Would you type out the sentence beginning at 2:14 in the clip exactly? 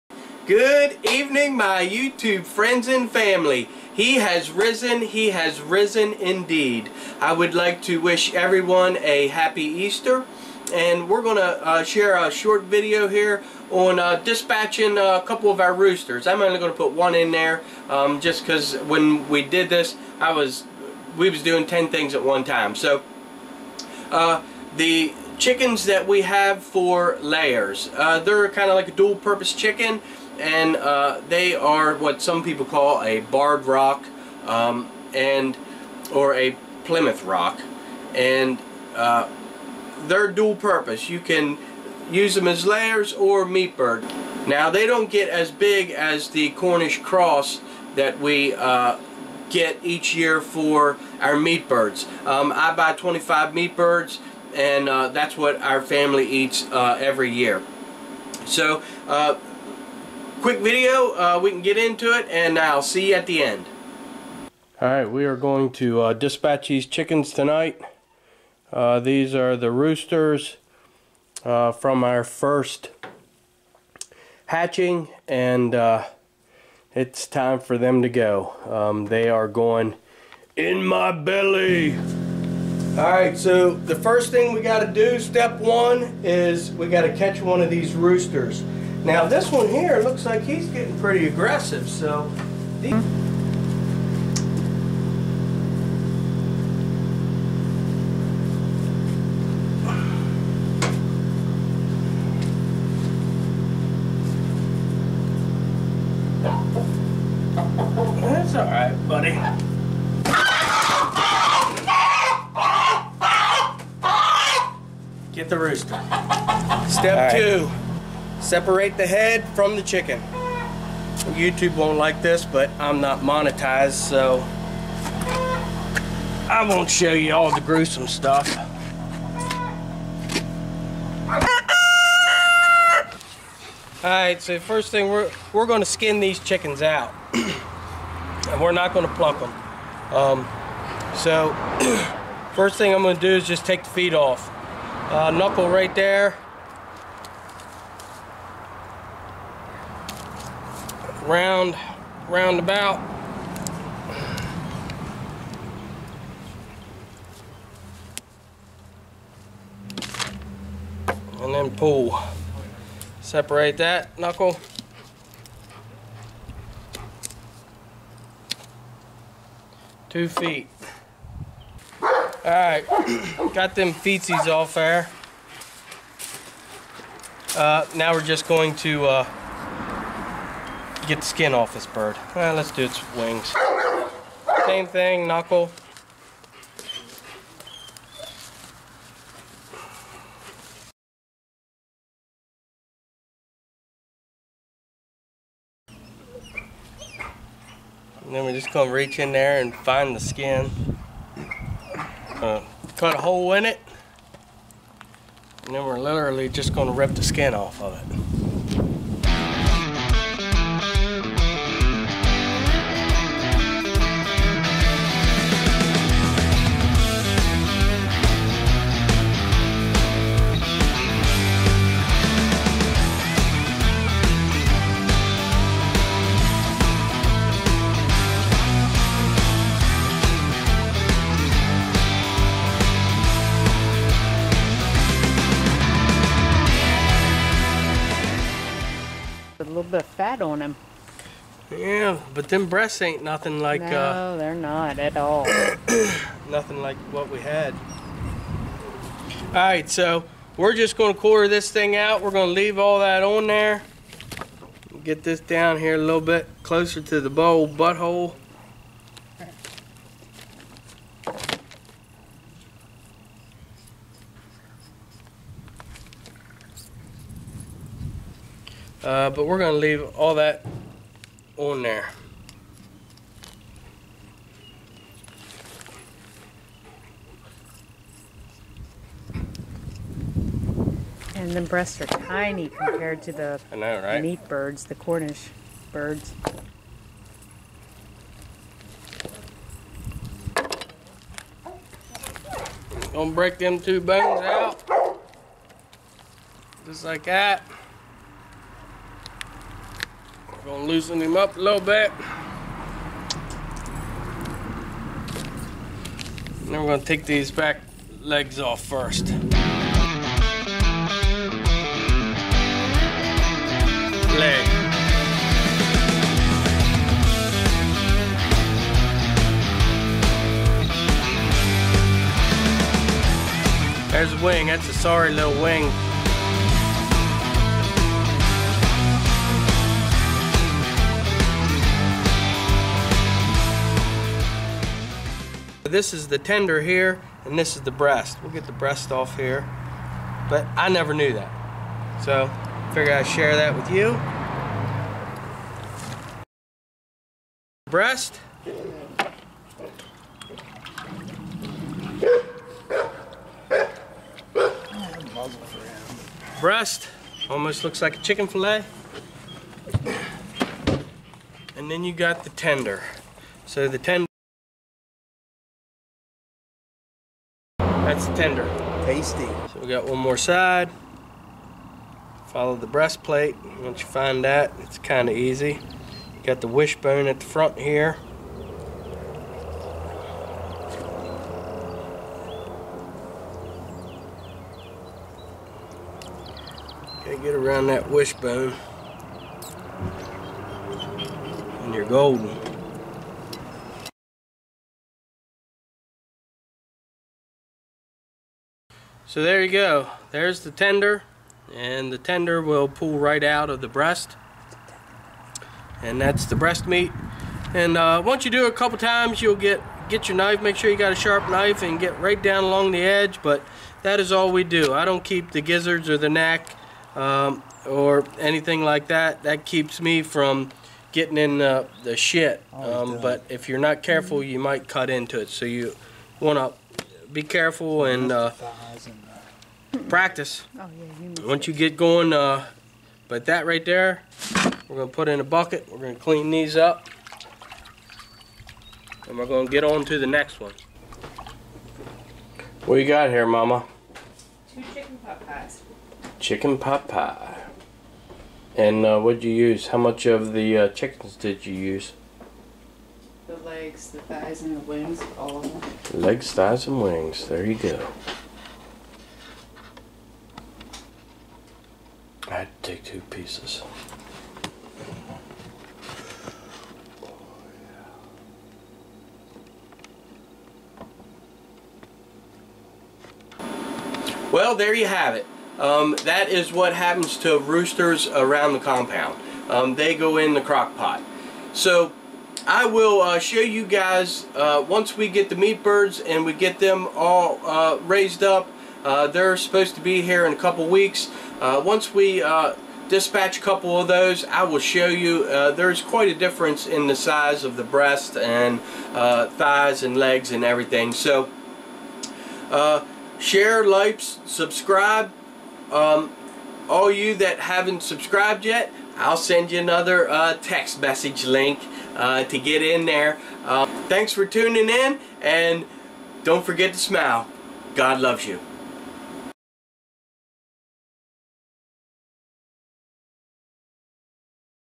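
Alright, so first thing, we're, we're going to skin these chickens out.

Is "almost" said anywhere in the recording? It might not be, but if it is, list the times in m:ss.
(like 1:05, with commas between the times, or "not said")
5:57.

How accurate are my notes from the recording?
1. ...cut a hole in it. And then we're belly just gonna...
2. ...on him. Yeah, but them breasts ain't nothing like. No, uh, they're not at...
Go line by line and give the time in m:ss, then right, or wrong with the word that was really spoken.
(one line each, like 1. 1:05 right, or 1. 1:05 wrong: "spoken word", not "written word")
1. 3:22 wrong: "literally", not "belly"
2. 4:00 right.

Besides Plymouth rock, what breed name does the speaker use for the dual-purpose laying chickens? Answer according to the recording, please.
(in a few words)
Barred rock.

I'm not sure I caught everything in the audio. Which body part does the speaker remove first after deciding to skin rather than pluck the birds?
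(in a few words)
The feet.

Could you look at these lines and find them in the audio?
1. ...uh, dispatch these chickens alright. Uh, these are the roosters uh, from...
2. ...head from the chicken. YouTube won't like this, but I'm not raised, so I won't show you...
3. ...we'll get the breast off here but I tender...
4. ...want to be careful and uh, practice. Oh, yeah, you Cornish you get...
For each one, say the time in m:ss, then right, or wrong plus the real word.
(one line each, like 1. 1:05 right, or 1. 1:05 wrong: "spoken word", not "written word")
1. 1:06 wrong: "tonight", not "alright"
2. 1:59 wrong: "monetized", not "raised"
3. 5:38 wrong: "never", not "tender"
4. 7:06 wrong: "Once", not "Cornish".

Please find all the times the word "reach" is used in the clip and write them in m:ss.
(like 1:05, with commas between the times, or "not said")
3:18.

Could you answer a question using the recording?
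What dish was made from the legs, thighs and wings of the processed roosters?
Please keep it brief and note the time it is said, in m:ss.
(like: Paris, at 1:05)
Chicken pot pie, at 7:26.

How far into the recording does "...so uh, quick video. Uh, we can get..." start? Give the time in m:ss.
0:58.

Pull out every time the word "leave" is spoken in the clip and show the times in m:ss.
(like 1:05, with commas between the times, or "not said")
4:12, 4:29.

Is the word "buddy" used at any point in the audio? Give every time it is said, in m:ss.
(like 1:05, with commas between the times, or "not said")
1:49.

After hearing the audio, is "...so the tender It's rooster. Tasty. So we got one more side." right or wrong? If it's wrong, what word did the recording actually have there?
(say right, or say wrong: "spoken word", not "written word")
wrong: "tender", not "rooster".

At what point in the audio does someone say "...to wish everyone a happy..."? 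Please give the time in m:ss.
0:07.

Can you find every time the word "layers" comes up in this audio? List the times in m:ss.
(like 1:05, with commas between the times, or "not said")
0:27, 0:42.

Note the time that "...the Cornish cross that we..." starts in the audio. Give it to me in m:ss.
0:46.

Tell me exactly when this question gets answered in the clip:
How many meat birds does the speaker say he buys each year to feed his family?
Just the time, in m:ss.
0:52.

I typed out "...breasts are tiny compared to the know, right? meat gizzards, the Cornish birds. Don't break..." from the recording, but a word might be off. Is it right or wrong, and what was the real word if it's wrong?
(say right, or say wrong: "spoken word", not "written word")
wrong: "birds", not "gizzards".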